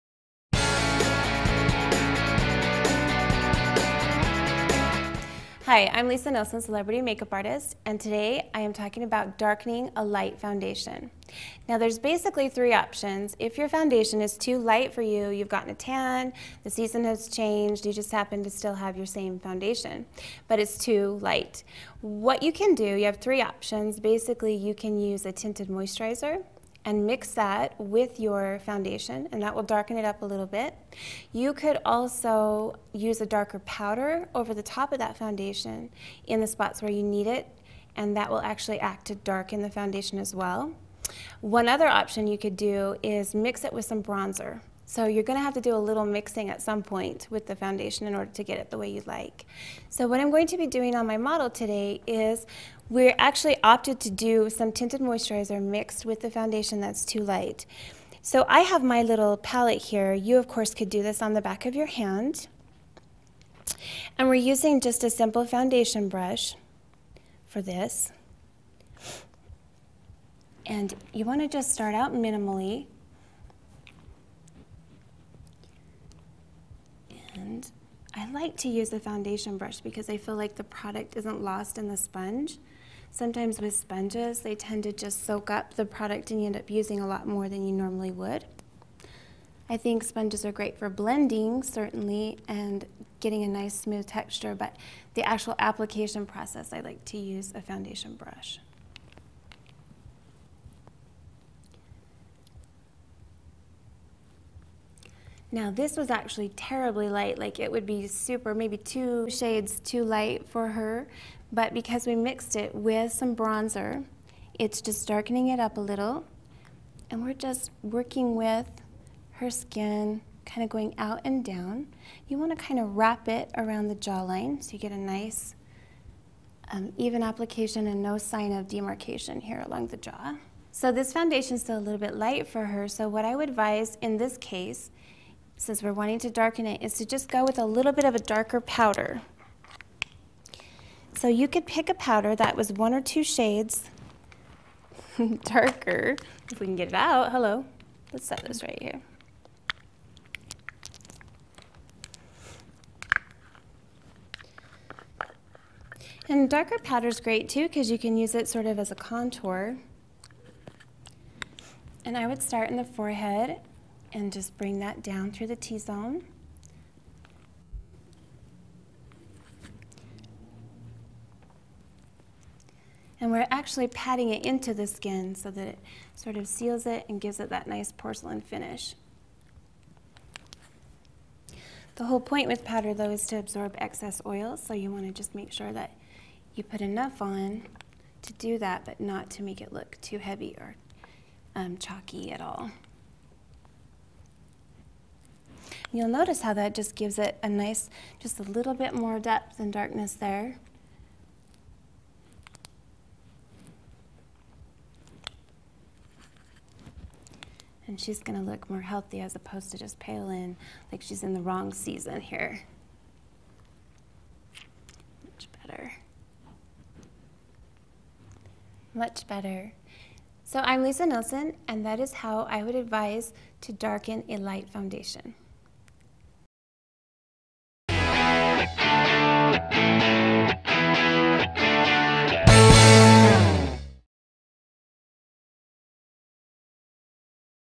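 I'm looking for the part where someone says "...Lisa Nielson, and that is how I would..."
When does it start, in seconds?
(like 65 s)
220 s.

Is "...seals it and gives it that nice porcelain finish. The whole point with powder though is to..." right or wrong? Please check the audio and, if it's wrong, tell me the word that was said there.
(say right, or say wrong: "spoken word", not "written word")
right.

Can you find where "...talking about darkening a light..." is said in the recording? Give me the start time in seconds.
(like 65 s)
8 s.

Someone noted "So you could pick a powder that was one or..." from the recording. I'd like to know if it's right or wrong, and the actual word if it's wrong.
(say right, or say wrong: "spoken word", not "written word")
right.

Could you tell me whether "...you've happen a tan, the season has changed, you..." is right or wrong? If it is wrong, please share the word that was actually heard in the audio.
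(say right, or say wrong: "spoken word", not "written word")
wrong: "gotten", not "happen".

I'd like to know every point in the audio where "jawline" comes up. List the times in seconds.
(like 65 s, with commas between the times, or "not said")
123 s.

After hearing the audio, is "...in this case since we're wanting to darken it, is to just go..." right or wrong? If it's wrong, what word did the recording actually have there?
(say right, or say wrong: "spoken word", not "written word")
right.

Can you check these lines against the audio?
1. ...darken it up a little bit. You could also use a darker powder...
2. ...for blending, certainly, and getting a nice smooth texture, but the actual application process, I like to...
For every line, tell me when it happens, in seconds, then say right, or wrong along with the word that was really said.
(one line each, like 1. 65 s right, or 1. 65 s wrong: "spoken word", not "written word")
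1. 29 s right
2. 90 s right.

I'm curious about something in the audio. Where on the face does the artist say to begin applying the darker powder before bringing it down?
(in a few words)
forehead.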